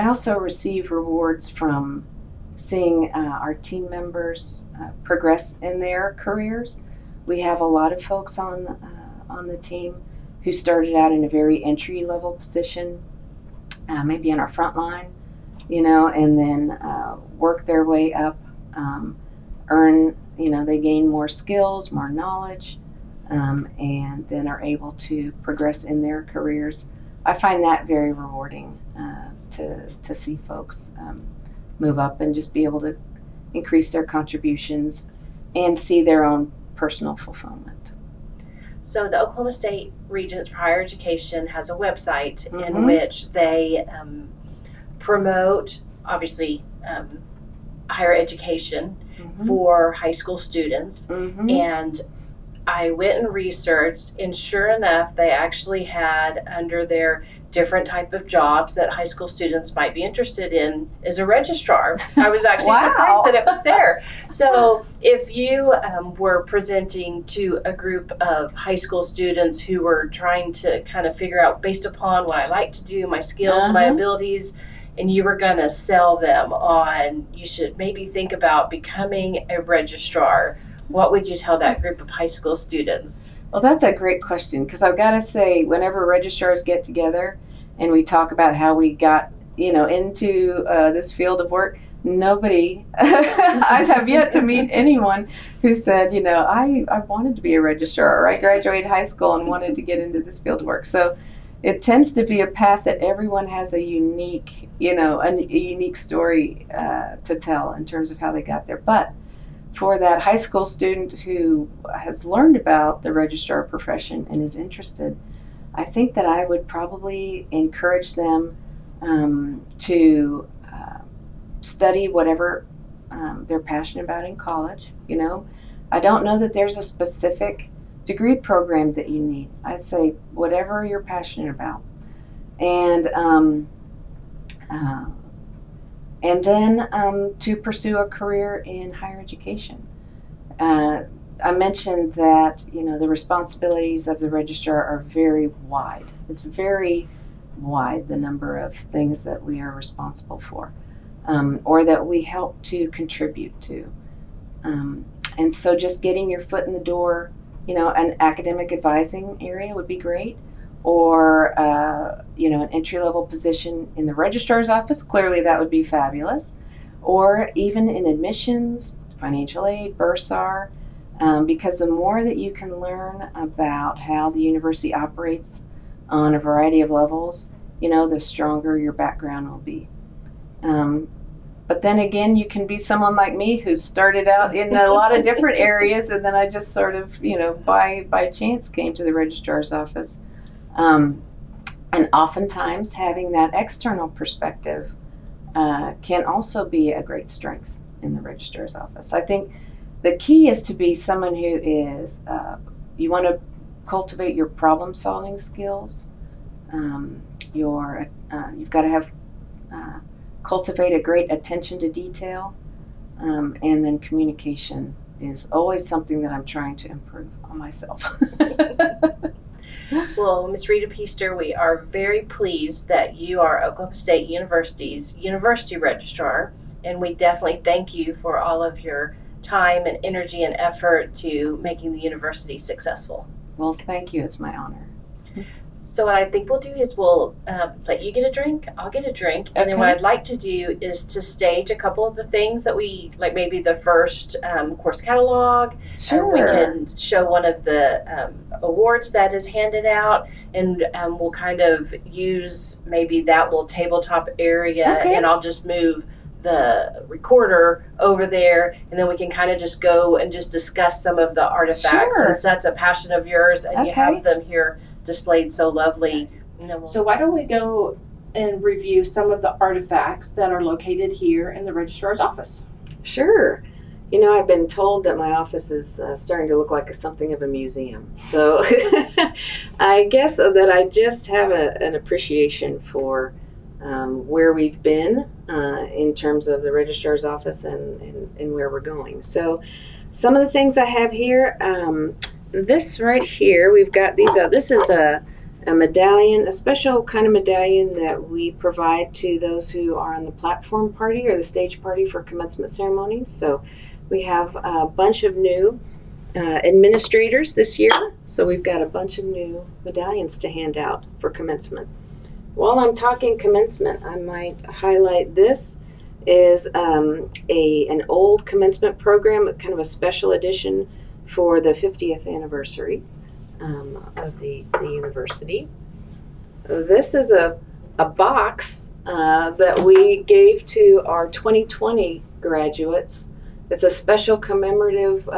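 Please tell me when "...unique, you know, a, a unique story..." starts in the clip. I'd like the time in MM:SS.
01:43.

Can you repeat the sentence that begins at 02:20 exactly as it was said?
Uh, I mentioned that you know the responsibilities of the registrar are very wide.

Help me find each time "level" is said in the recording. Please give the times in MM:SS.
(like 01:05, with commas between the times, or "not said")
00:12, 02:42, 02:56.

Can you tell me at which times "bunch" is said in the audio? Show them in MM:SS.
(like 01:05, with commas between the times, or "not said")
05:04, 05:08.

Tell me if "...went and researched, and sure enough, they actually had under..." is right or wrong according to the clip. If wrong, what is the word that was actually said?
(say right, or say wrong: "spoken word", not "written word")
right.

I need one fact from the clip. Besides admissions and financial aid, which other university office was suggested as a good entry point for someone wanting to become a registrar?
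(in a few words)
Bursar.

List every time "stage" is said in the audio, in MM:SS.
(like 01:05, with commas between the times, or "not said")
04:01, 05:01.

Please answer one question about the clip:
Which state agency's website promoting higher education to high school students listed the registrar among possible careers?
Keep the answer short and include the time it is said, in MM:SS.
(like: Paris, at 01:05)
Oklahoma State Regents for Higher Education, at 00:39.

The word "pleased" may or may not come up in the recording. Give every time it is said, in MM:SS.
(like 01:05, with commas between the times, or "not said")
03:42.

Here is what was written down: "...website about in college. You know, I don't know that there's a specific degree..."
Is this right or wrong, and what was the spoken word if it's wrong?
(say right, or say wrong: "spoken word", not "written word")
wrong: "passionate", not "website".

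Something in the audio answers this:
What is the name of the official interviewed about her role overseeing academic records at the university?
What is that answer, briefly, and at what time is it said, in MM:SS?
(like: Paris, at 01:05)
Rita Peaster, at 03:40.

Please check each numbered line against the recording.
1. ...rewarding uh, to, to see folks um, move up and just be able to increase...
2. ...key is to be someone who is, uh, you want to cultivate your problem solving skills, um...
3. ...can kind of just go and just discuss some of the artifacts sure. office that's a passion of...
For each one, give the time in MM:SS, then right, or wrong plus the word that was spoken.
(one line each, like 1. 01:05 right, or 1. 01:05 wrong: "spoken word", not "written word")
1. 00:28 right
2. 03:20 right
3. 04:19 wrong: "since", not "office".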